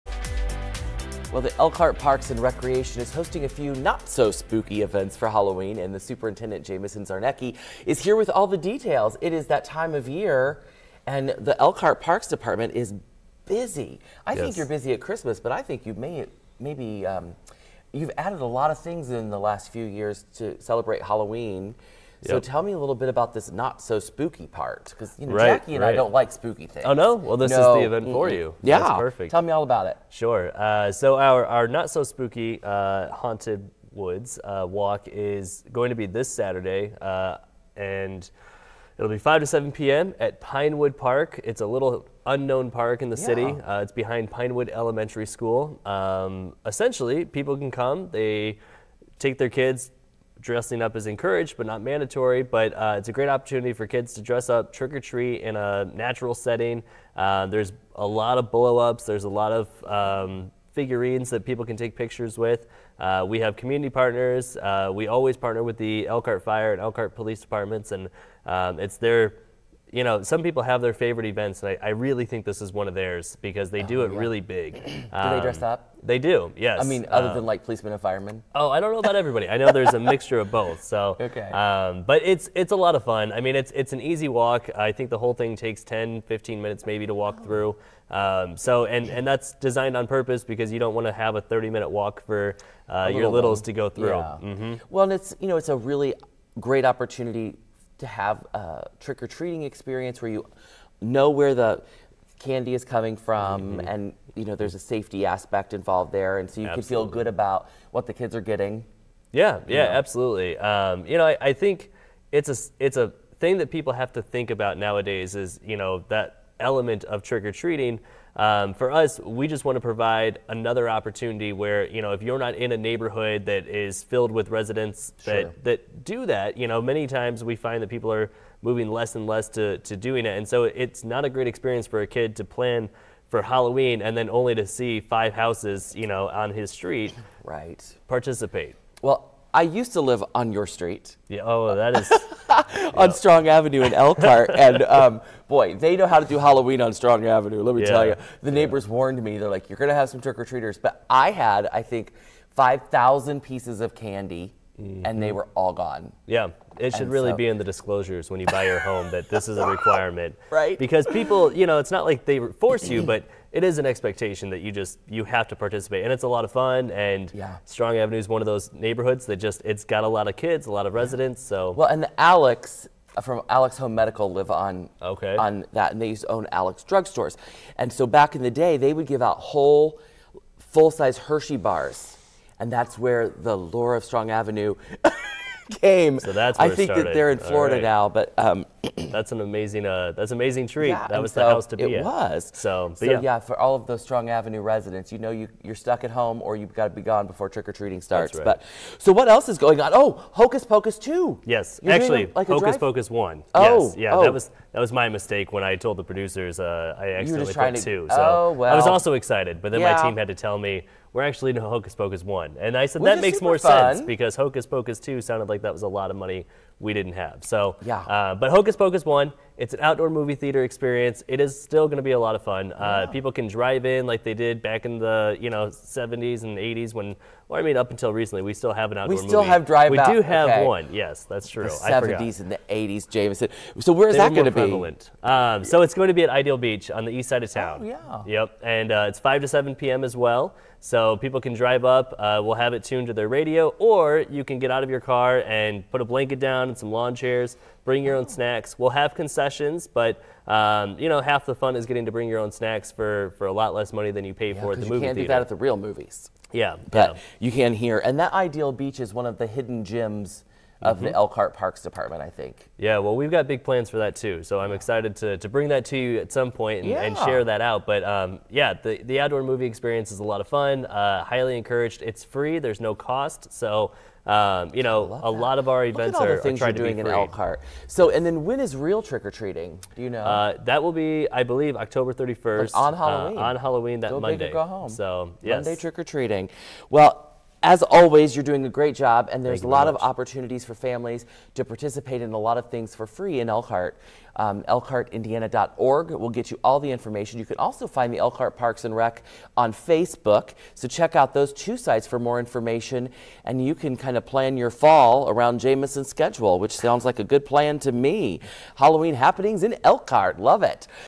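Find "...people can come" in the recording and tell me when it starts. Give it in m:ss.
0:47.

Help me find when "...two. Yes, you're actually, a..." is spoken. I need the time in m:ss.
3:20.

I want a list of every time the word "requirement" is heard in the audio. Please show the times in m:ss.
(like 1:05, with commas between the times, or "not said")
2:39.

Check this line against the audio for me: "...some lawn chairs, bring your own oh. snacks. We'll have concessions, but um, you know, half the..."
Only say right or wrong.
right.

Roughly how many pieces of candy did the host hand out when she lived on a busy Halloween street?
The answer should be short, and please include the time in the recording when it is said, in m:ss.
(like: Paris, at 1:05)
5000, at 2:32.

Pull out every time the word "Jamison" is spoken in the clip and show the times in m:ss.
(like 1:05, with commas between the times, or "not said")
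0:06, 3:53, 5:05.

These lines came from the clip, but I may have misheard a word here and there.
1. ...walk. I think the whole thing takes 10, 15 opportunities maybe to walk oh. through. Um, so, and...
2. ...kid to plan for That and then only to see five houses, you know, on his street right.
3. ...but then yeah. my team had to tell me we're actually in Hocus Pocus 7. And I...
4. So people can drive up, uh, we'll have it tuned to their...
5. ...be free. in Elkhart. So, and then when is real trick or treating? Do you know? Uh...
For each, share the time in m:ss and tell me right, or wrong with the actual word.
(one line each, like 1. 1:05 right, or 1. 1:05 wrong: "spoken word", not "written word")
1. 1:24 wrong: "minutes", not "opportunities"
2. 2:12 wrong: "Halloween", not "That"
3. 3:29 wrong: "1", not "7"
4. 4:00 right
5. 4:36 right.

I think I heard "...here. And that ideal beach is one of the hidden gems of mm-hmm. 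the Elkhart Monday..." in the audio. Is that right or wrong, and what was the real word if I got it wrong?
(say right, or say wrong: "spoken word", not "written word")
wrong: "Parks", not "Monday".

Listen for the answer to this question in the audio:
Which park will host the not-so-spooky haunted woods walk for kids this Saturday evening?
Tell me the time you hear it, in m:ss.
0:40.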